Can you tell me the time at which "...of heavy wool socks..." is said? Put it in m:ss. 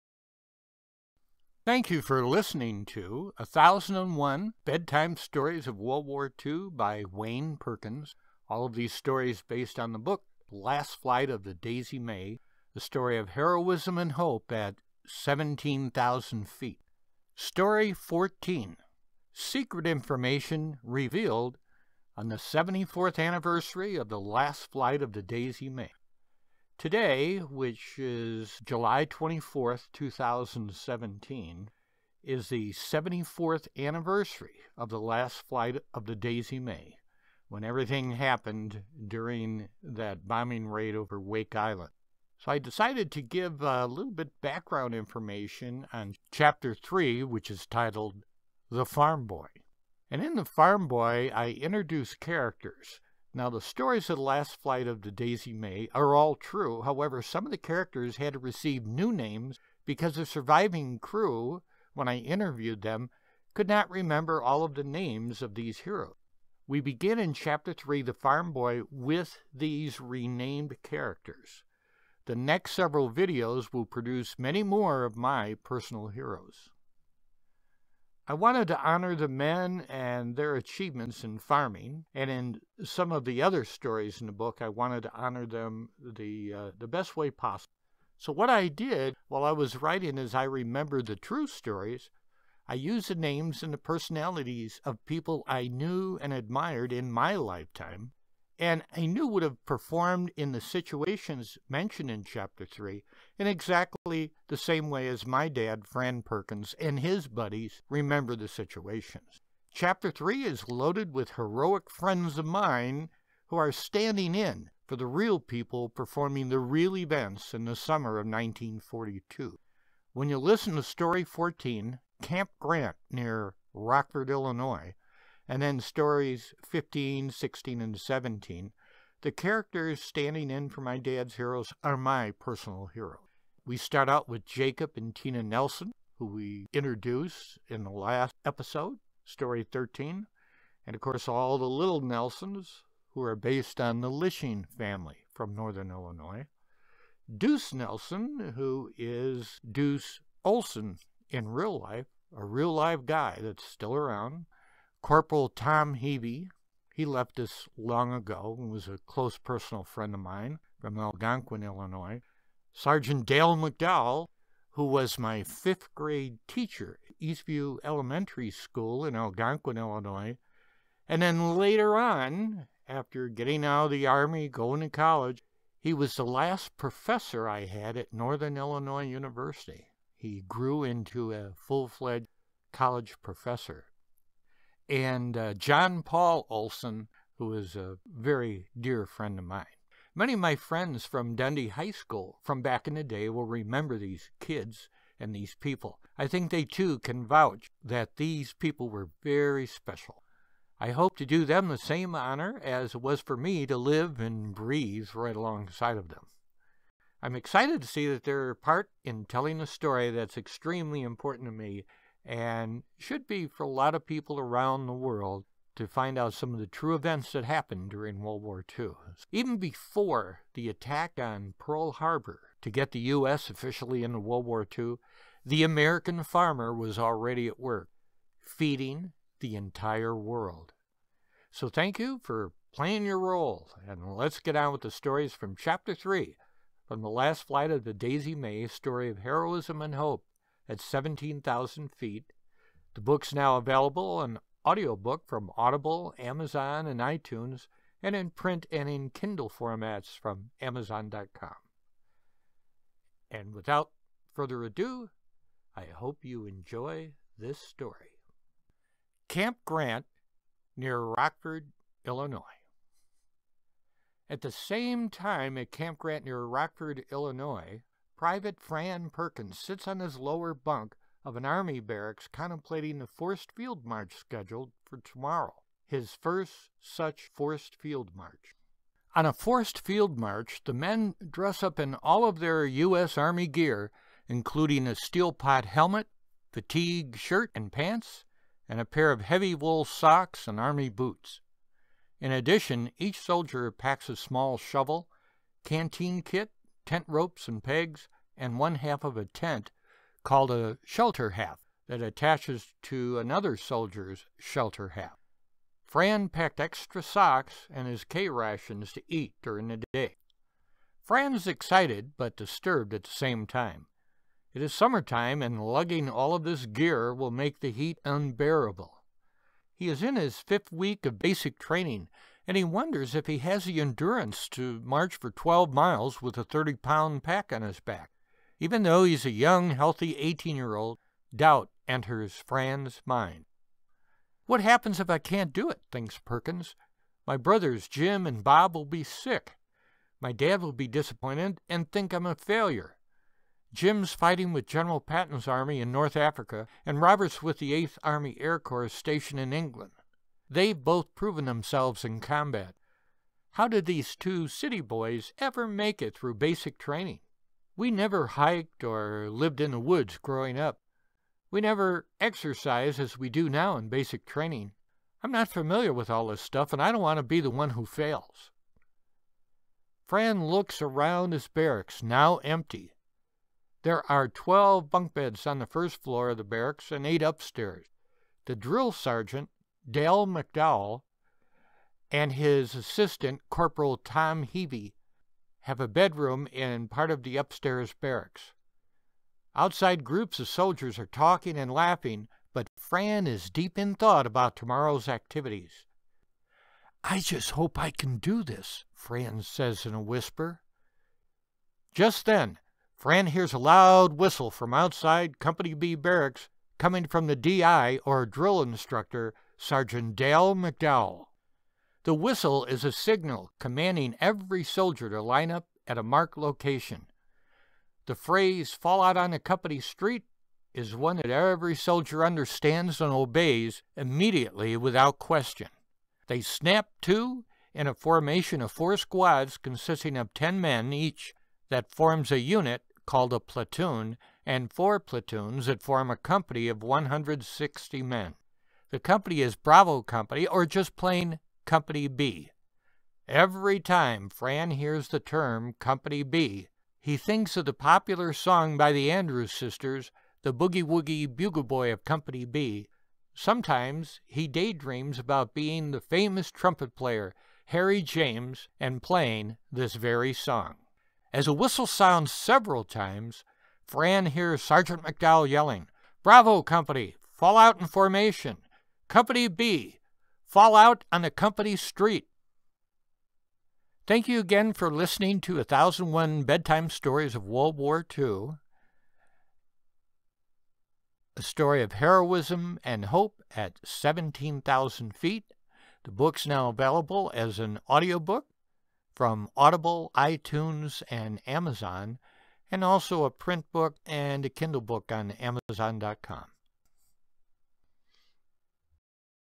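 4:49.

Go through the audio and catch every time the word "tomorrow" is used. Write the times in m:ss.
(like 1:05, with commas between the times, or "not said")
4:34, 6:34.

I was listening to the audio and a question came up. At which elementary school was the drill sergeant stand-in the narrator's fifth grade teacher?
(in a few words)
Eastview Elementary School.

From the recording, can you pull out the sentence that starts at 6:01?
We never exercise as we do now in basic training.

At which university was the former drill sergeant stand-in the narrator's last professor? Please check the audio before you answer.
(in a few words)
Northern Illinois University.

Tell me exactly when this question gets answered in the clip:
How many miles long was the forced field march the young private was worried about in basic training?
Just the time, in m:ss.
5:25.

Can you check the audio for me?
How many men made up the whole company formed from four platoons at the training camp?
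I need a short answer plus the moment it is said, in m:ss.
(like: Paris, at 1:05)
160, at 7:16.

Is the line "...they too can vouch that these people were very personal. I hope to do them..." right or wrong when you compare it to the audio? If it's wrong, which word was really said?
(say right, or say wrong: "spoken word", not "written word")
wrong: "special", not "personal".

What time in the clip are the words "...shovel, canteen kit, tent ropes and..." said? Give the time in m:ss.
4:54.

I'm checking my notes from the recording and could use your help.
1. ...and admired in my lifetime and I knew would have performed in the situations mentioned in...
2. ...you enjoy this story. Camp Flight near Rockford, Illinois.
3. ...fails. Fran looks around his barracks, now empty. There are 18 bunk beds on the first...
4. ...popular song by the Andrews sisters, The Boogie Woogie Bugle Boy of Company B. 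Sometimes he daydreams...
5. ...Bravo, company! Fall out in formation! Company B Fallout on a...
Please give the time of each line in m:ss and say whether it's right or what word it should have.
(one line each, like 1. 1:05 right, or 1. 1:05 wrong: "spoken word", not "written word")
1. 1:36 right
2. 4:16 wrong: "Grant", not "Flight"
3. 6:07 wrong: "12", not "18"
4. 7:27 right
5. 7:46 right.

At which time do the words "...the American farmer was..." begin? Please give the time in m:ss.
3:45.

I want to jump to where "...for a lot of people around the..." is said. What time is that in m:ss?
3:33.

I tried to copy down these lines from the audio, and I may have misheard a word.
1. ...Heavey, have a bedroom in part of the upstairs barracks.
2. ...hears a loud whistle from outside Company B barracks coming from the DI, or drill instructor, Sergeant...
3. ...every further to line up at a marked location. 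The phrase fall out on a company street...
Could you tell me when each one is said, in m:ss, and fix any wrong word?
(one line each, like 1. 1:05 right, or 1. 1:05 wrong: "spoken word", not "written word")
1. 6:24 right
2. 6:43 right
3. 6:54 wrong: "soldier", not "further".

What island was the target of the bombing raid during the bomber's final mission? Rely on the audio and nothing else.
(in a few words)
Wake Island.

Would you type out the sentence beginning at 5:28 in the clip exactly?
Even though he's a young, healthy 18 year old, doubt enters Fran's mind.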